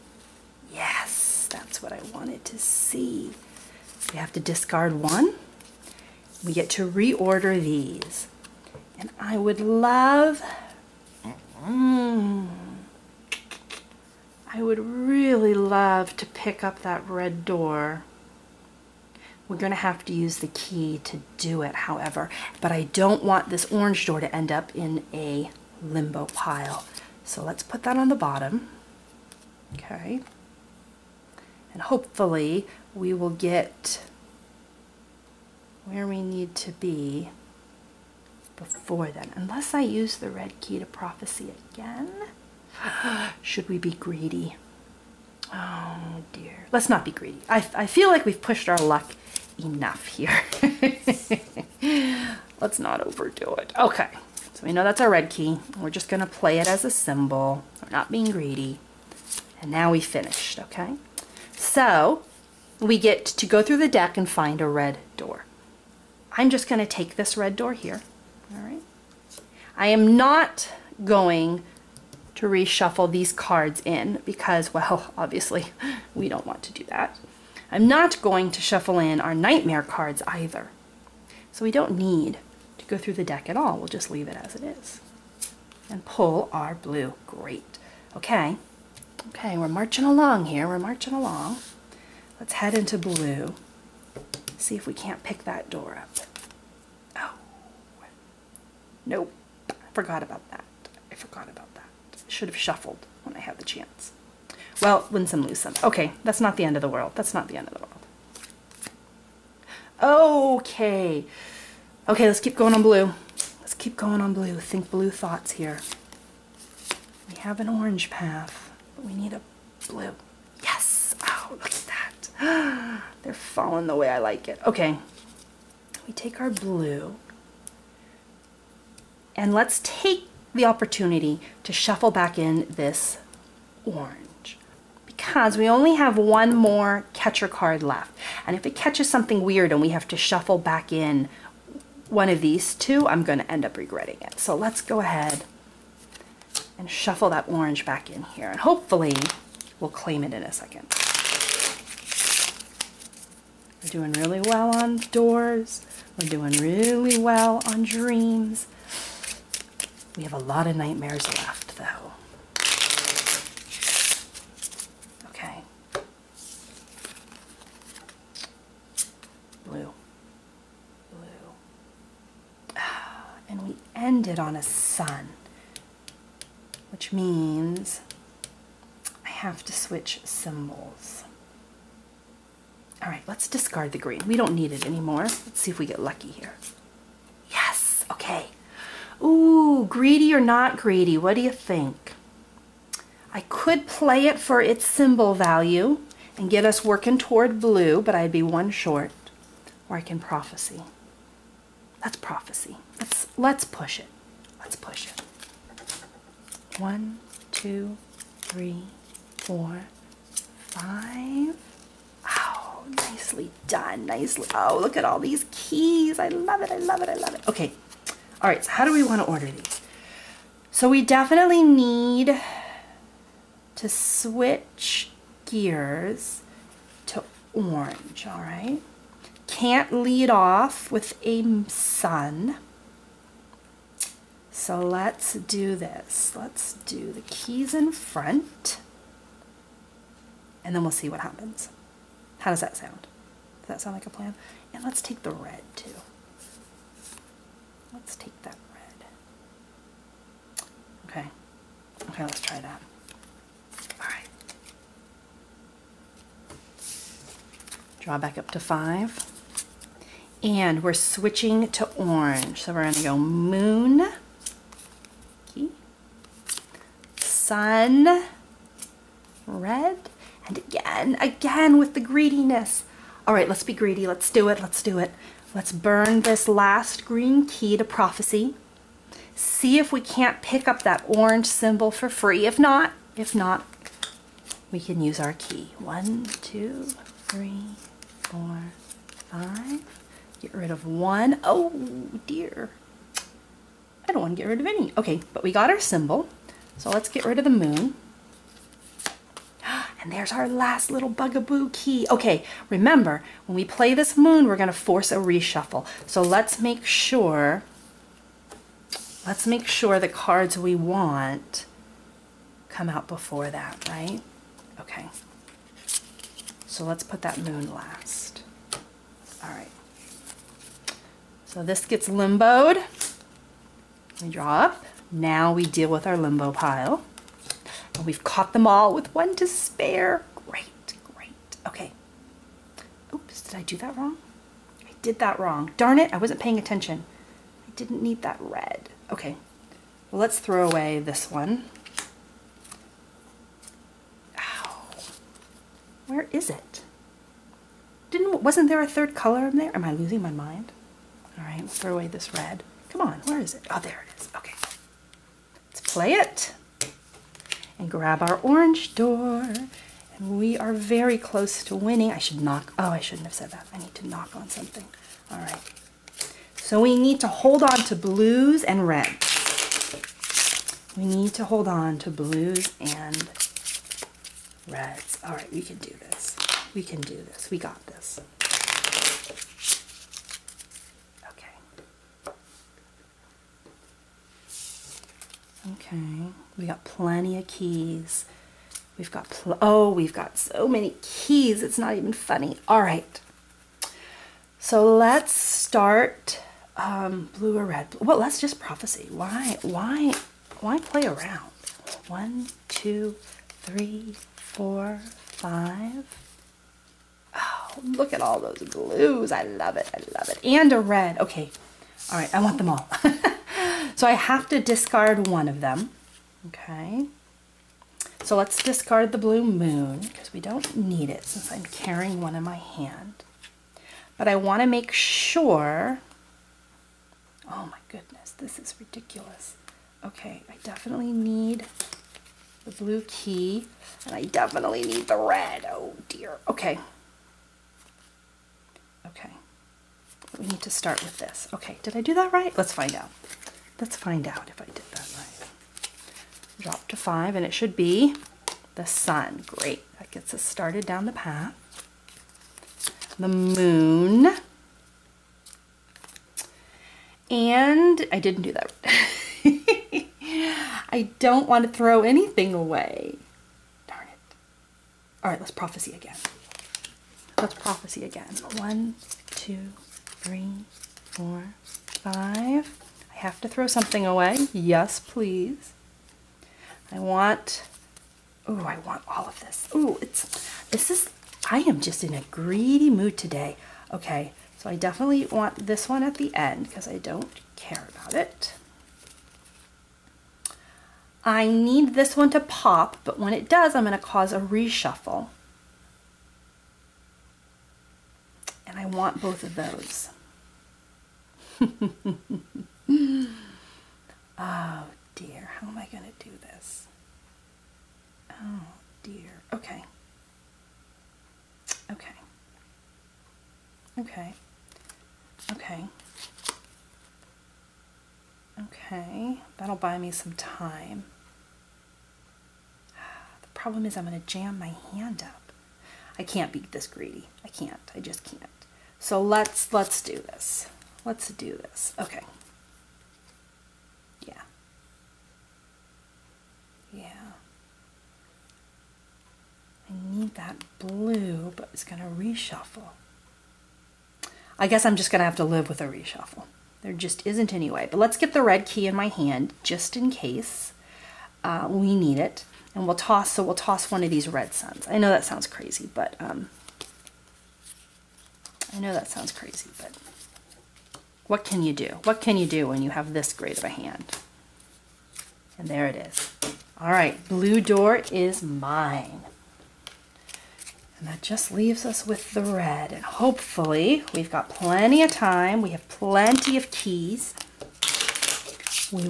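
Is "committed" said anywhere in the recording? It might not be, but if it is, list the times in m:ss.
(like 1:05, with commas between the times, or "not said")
not said.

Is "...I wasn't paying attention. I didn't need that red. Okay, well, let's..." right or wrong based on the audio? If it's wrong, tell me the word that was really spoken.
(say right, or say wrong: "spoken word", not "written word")
right.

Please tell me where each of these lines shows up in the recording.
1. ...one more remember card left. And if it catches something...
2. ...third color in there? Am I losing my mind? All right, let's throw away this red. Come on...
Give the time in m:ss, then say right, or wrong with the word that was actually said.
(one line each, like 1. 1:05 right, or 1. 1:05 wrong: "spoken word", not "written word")
1. 2:16 wrong: "catcher", not "remember"
2. 5:48 right.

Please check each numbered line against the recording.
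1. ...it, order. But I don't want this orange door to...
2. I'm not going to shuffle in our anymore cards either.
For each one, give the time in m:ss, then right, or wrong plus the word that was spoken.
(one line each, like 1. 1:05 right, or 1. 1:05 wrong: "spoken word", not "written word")
1. 0:21 wrong: "however", not "order"
2. 1:17 wrong: "nightmare", not "anymore".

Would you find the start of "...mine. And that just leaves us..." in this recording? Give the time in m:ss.
9:28.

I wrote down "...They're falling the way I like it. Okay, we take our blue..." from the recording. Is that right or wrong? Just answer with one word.
right.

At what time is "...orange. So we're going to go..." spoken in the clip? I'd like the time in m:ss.
4:21.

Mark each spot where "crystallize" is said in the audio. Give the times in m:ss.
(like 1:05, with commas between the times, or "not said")
not said.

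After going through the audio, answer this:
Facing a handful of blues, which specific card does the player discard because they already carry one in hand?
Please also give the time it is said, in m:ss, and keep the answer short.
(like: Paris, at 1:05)
blue moon, at 6:59.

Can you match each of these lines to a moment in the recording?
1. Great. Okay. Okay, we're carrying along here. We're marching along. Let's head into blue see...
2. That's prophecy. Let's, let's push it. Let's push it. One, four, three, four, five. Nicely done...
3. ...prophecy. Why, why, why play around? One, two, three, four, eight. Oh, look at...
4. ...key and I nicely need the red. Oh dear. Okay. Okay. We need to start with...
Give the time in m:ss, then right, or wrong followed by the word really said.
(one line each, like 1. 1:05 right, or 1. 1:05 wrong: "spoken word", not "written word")
1. 1:27 wrong: "marching", not "carrying"
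2. 3:22 wrong: "two", not "four"
3. 6:38 wrong: "five", not "eight"
4. 7:13 wrong: "definitely", not "nicely".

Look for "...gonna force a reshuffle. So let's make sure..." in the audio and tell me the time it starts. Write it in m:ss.
5:04.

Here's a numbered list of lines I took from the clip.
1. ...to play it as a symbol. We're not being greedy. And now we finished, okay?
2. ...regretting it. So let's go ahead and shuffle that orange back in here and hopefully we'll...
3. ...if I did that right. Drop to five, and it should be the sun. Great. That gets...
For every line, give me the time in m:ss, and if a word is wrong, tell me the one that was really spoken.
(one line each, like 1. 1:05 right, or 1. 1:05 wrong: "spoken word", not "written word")
1. 0:56 right
2. 2:23 right
3. 7:24 right.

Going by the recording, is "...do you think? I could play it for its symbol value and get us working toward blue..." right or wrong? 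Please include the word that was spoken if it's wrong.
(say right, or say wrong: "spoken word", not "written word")
right.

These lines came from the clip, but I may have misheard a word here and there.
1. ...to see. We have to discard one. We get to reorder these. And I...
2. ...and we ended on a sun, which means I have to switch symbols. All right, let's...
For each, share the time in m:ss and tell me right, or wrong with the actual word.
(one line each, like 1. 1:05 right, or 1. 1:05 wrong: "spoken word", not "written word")
1. 0:02 right
2. 2:53 right.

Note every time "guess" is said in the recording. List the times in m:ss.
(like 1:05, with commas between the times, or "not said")
9:04.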